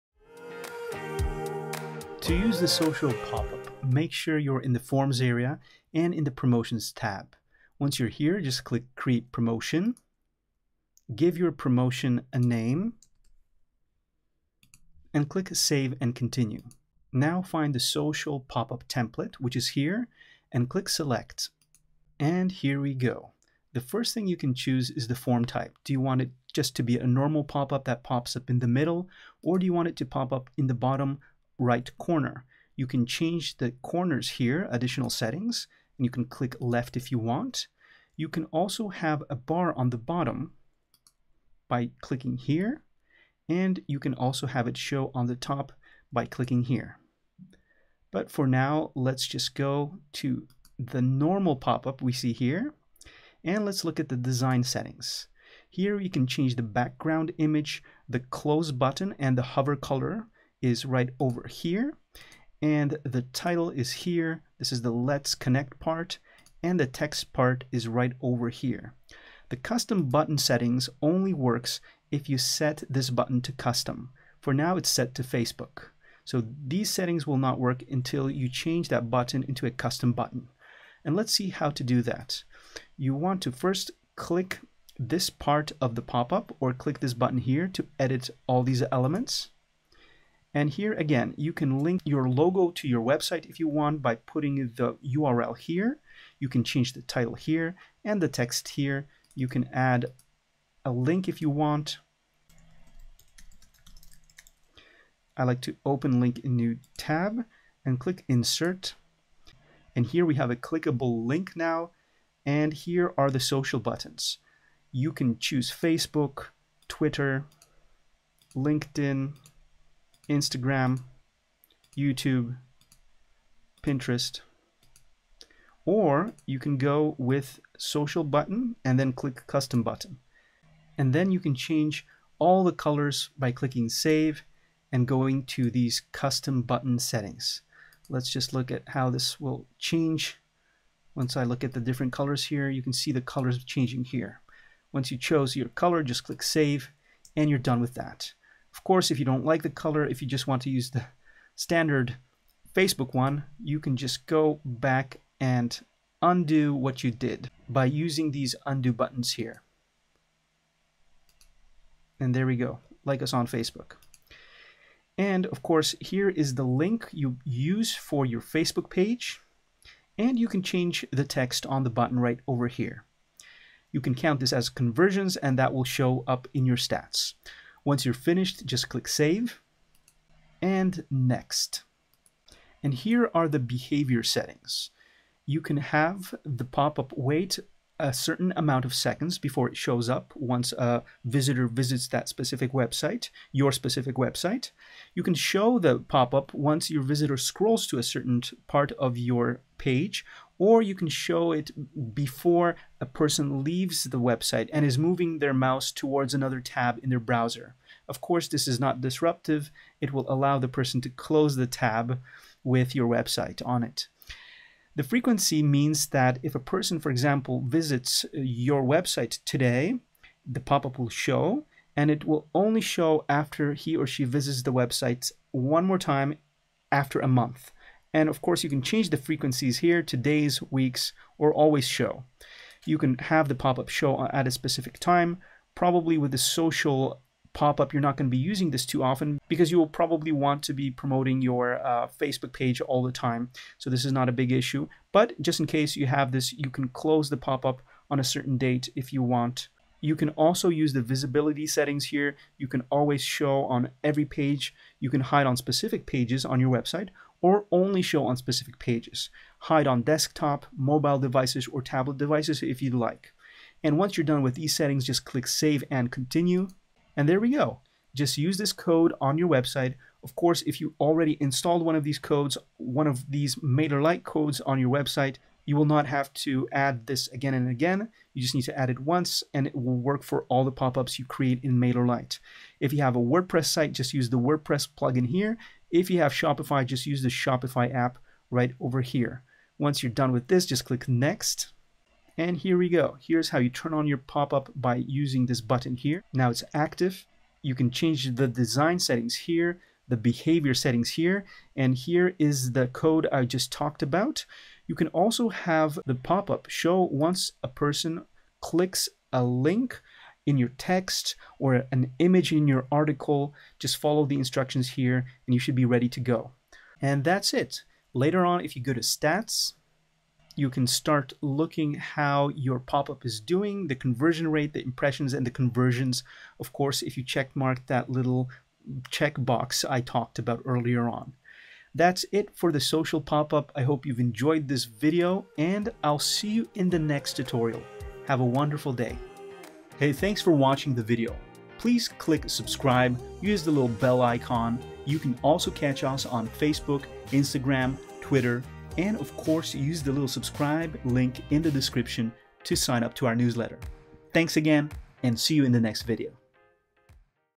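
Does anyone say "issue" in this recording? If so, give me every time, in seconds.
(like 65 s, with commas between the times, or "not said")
244 s.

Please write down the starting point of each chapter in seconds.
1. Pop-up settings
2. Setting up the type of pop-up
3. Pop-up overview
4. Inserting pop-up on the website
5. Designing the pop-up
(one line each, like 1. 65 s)
1. 182 s
2. 16 s
3. 292 s
4. 266 s
5. 53 s.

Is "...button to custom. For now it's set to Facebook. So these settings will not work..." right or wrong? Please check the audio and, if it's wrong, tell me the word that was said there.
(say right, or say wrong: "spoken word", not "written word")
right.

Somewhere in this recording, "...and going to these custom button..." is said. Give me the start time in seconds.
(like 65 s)
134 s.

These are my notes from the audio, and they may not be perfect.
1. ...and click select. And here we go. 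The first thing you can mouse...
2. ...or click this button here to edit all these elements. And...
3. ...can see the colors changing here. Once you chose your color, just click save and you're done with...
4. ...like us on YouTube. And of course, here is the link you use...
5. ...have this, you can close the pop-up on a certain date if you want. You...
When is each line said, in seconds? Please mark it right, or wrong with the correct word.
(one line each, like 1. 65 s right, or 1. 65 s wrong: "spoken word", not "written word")
1. 20 s wrong: "choose", not "mouse"
2. 86 s right
3. 142 s right
4. 163 s wrong: "Facebook", not "YouTube"
5. 246 s right.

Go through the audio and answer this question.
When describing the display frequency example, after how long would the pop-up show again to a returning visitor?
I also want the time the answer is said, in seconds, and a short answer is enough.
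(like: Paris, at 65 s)
A month, at 227 s.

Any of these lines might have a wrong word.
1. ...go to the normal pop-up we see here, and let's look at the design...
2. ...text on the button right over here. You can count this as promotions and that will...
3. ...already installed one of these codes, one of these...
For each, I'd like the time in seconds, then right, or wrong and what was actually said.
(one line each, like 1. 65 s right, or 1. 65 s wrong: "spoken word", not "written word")
1. 49 s right
2. 171 s wrong: "conversions", not "promotions"
3. 270 s right.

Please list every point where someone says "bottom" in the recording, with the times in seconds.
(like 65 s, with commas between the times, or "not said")
30 s, 39 s.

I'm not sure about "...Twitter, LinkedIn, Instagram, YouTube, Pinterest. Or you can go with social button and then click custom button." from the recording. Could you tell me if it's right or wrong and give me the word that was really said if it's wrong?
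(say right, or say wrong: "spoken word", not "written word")
right.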